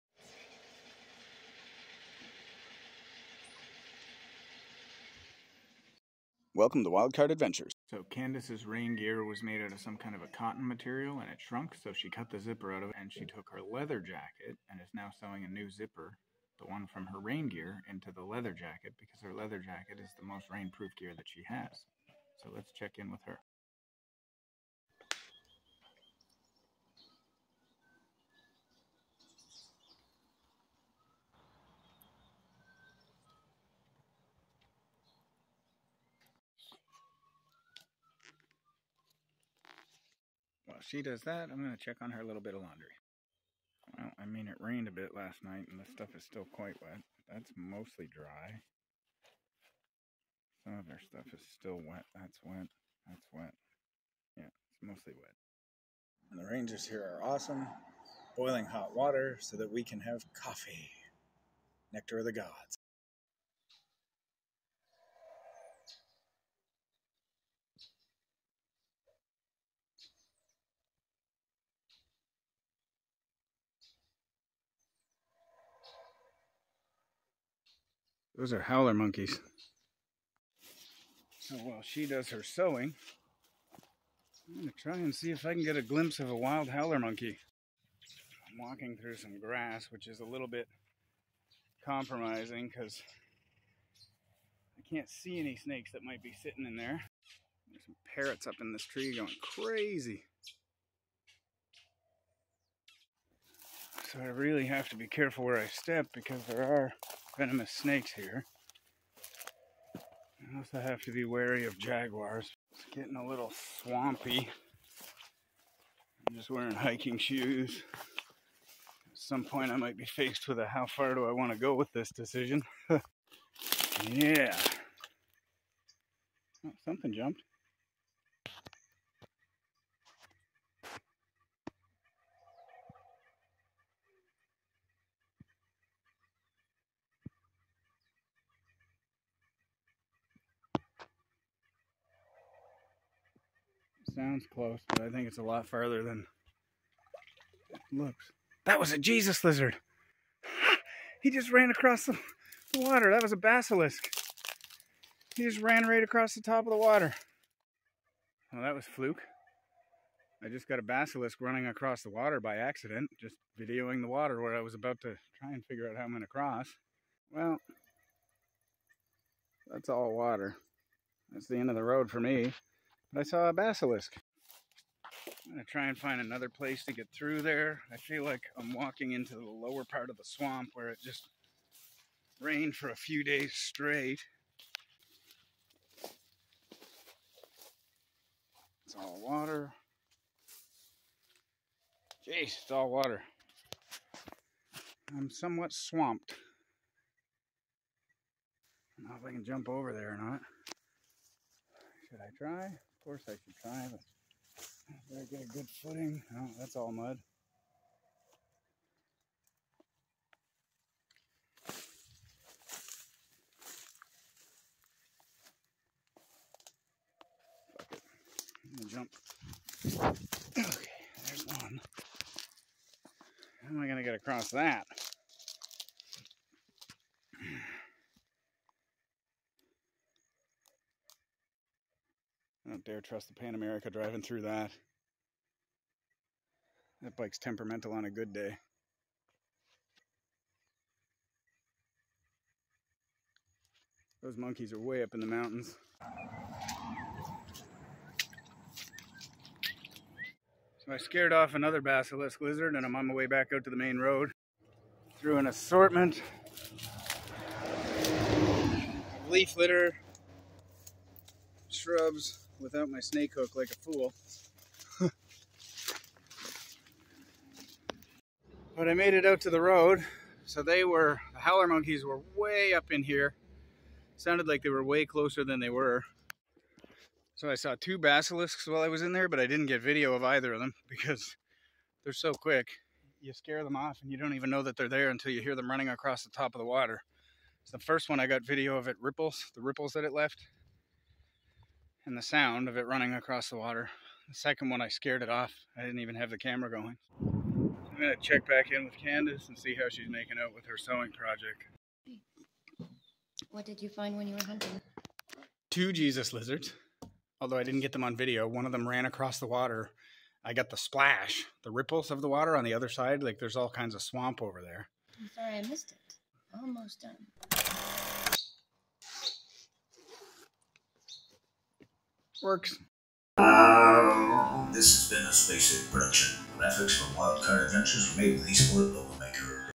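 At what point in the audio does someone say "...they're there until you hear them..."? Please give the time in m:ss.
4:44.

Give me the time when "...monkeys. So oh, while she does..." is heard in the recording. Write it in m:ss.
1:18.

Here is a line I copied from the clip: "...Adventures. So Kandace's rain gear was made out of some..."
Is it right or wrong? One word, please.
right.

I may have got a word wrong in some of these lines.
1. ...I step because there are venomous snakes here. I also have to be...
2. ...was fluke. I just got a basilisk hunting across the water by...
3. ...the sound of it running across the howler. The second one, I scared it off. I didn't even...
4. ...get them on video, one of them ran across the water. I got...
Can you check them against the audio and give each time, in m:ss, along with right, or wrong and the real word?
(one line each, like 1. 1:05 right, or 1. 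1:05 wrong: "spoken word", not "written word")
1. 1:45 right
2. 2:38 wrong: "running", not "hunting"
3. 4:52 wrong: "water", not "howler"
4. 5:07 right.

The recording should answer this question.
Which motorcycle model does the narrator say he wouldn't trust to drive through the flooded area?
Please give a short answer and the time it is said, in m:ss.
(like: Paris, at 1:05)
Pan America, at 3:53.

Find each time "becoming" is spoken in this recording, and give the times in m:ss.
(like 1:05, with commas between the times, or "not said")
not said.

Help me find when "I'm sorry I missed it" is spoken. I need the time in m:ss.
5:15.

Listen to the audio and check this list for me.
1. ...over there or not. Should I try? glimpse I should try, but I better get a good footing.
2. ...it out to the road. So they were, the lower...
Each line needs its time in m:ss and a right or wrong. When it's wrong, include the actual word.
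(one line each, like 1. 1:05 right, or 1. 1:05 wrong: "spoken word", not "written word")
1. 3:19 wrong: "course", not "glimpse"
2. 4:29 wrong: "howler", not "lower".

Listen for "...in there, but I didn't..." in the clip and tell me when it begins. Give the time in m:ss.
4:39.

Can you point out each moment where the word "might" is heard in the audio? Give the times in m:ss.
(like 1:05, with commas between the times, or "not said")
1:36, 1:59.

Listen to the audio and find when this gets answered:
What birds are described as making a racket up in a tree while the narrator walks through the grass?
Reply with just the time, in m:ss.
1:38.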